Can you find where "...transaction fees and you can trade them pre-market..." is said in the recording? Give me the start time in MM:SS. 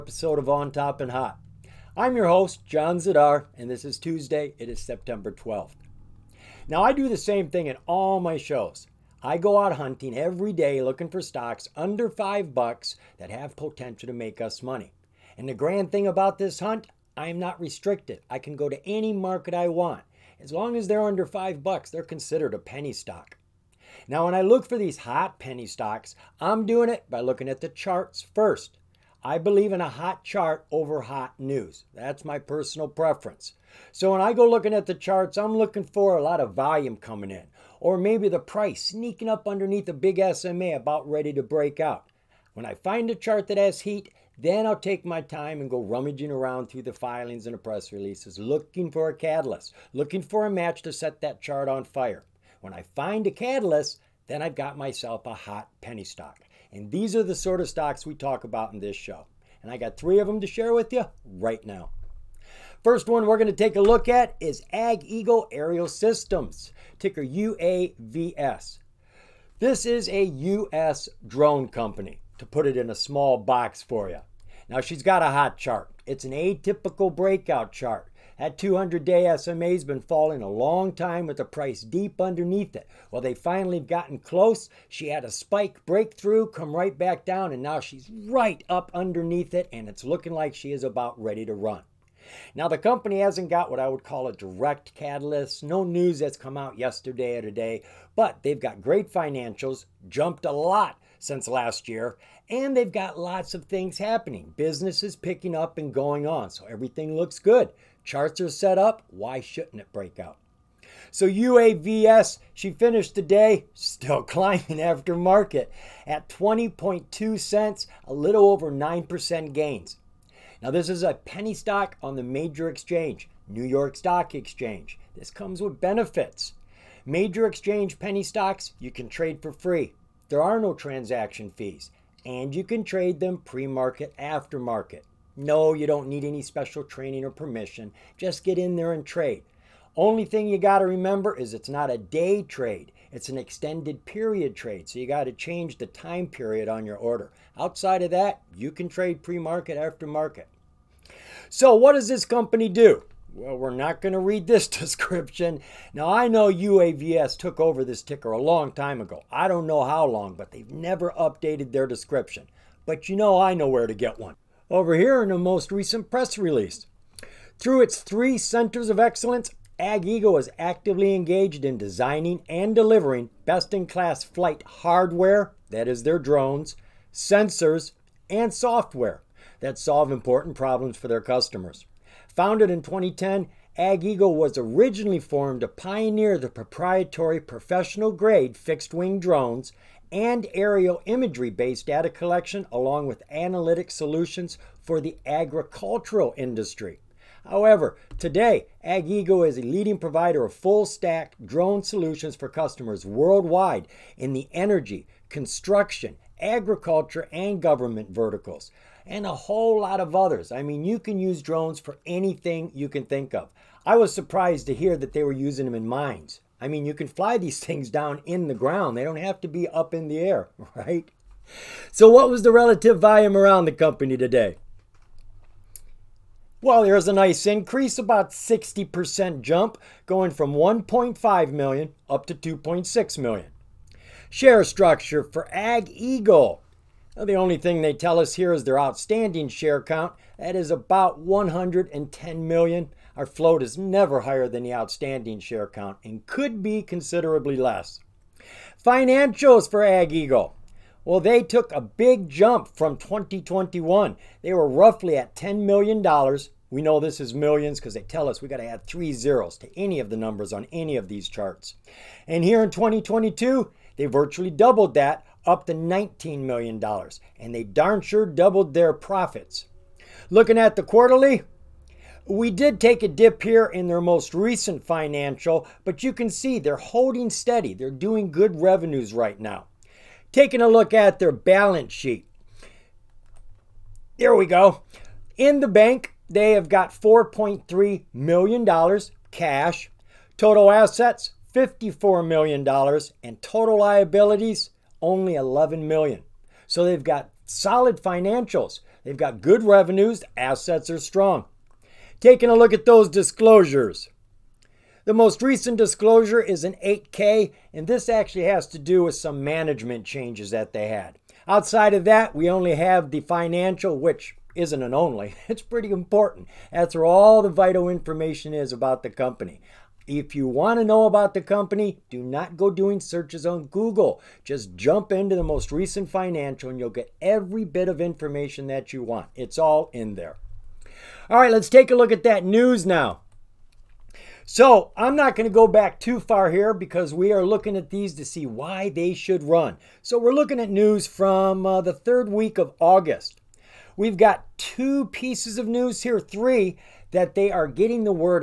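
02:10.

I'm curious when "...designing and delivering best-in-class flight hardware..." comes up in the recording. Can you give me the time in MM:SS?
02:51.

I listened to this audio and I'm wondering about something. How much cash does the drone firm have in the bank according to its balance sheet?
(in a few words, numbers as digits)
$4.3 million.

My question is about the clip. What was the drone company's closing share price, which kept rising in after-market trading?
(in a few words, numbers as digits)
20.2 cents.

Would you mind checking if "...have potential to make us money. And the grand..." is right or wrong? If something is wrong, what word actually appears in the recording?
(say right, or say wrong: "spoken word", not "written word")
right.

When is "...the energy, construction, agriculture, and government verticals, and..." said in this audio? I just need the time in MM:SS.
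03:24.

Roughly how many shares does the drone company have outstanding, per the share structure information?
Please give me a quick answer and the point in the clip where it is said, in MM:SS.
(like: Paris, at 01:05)
110 million, at 04:01.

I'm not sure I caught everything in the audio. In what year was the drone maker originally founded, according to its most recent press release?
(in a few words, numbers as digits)
2010.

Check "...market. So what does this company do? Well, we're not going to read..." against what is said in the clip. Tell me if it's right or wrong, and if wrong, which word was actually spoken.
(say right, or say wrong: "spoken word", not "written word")
right.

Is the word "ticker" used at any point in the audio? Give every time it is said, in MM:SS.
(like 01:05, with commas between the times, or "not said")
01:06, 02:38.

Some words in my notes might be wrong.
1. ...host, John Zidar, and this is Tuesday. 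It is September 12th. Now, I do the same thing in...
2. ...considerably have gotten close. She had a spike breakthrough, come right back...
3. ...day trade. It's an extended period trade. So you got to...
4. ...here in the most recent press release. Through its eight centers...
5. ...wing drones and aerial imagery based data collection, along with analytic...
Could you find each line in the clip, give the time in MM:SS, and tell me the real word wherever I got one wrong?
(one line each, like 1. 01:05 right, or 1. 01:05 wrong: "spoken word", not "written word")
1. 00:02 right
2. 01:23 wrong: "finally", not "considerably"
3. 02:21 right
4. 02:44 wrong: "three", not "eight"
5. 03:08 right.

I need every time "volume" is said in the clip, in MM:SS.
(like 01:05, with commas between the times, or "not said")
00:36, 03:42.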